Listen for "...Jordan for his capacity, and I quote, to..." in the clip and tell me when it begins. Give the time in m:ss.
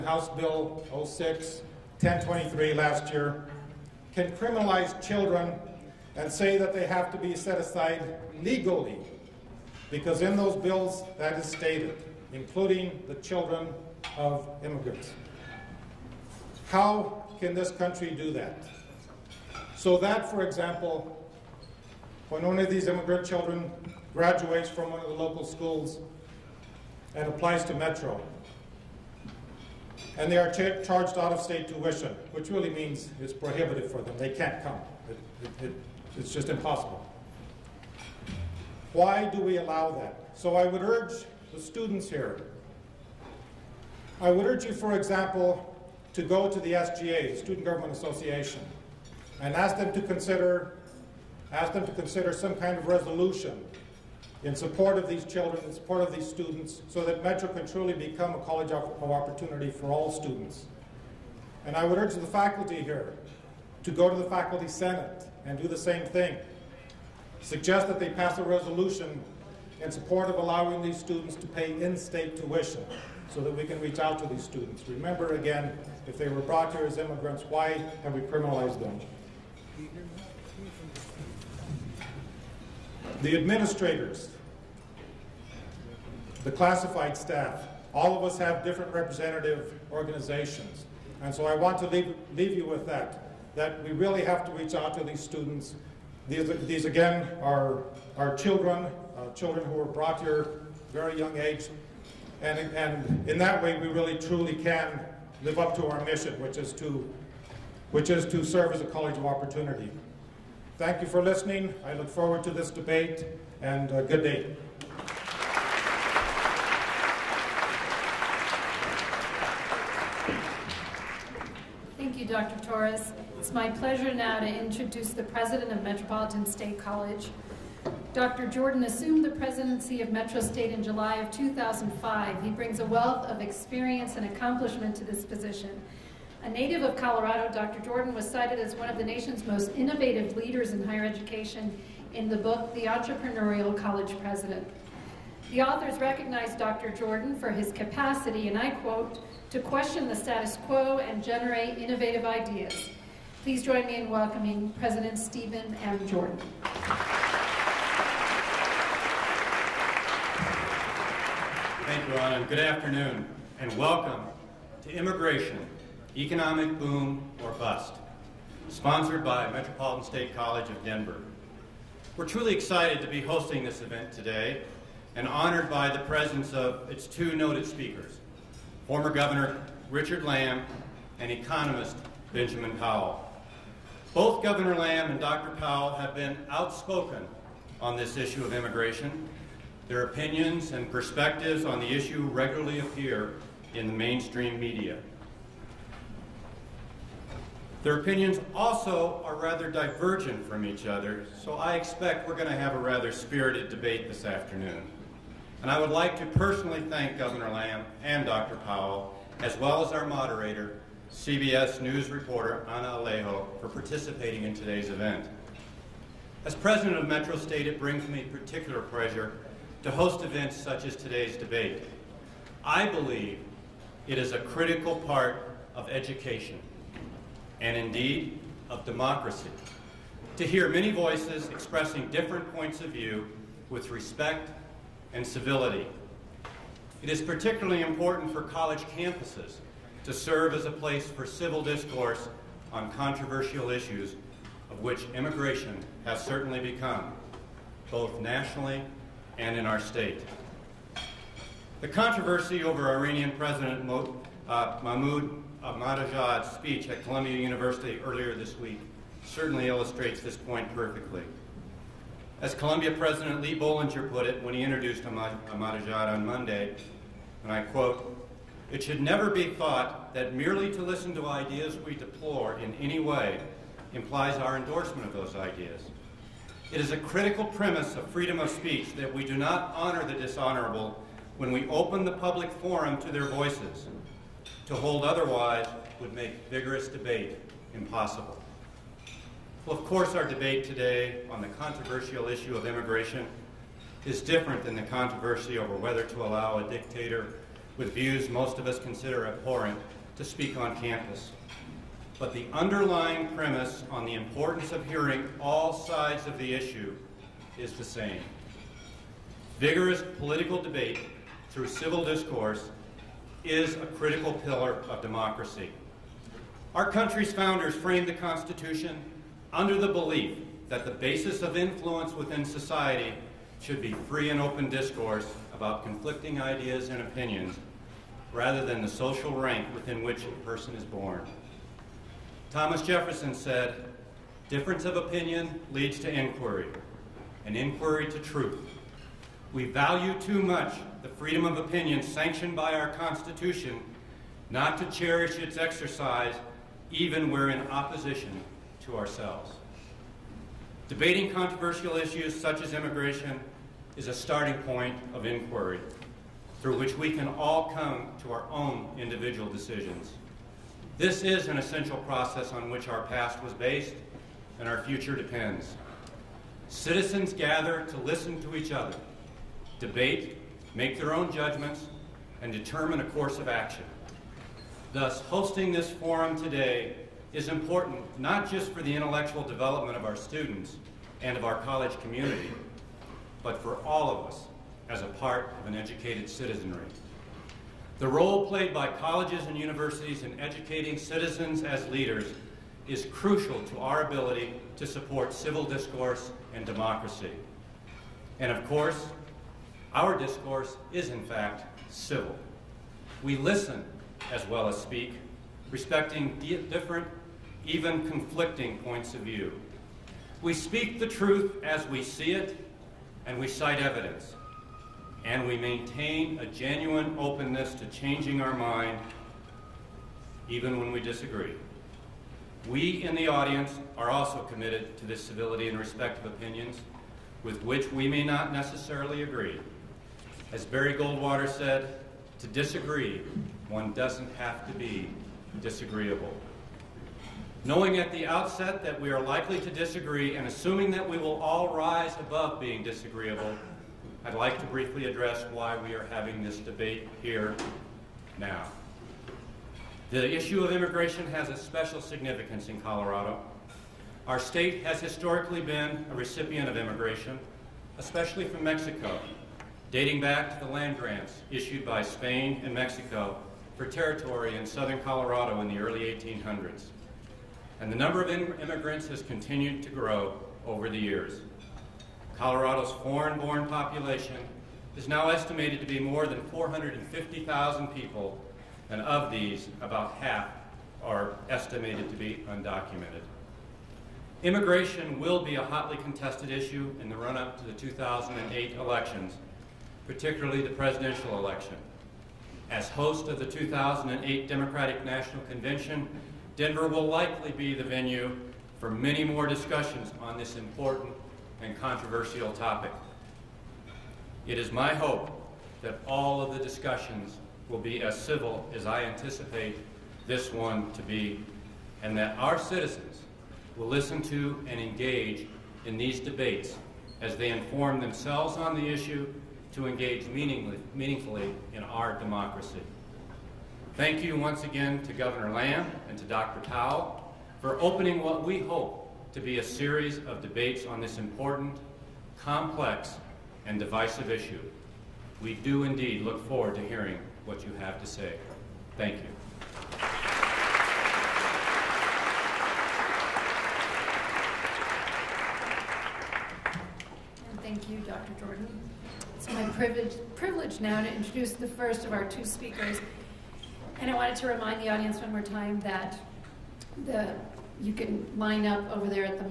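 2:26.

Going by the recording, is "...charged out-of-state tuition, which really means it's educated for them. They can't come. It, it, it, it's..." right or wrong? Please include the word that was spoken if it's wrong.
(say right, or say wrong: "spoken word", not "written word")
wrong: "prohibited", not "educated".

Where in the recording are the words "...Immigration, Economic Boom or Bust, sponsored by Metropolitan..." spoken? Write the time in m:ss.
2:44.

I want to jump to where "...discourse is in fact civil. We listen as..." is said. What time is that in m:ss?
6:40.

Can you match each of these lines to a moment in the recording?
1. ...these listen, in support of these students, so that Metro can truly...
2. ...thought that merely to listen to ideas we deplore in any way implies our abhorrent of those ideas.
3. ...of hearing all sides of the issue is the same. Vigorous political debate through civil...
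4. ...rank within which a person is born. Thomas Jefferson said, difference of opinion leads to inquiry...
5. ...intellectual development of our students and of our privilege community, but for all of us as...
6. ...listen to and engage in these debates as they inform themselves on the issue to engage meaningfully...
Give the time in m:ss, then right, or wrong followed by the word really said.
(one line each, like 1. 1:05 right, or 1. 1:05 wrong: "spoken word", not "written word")
1. 0:55 wrong: "children", not "listen"
2. 4:29 wrong: "endorsement", not "abhorrent"
3. 5:04 right
4. 5:29 right
5. 6:18 wrong: "college", not "privilege"
6. 8:33 right.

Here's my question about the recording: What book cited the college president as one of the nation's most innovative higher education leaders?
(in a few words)
The Entrepreneurial College President.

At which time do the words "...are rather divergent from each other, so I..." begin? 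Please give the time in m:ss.
3:19.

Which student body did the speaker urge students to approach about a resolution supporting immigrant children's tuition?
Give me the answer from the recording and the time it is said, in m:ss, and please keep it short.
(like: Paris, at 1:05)
Student Government Association, at 0:47.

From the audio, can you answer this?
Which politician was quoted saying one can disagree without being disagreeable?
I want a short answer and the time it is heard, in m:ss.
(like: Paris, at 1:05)
Barry Goldwater, at 7:10.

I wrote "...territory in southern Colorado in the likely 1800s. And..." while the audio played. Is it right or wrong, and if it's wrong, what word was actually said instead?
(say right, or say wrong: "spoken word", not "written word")
wrong: "early", not "likely".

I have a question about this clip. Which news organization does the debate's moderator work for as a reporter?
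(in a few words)
CBS News.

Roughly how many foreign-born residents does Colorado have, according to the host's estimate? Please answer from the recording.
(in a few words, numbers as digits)
450,000.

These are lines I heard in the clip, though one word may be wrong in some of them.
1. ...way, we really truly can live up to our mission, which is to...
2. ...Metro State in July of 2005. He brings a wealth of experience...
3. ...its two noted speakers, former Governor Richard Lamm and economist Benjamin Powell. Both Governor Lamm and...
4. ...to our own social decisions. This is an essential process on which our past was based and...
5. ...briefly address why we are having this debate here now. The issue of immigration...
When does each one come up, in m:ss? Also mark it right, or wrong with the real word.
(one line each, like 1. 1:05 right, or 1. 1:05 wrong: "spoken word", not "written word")
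1. 1:43 right
2. 2:10 right
3. 2:56 right
4. 5:58 wrong: "individual", not "social"
5. 7:24 right.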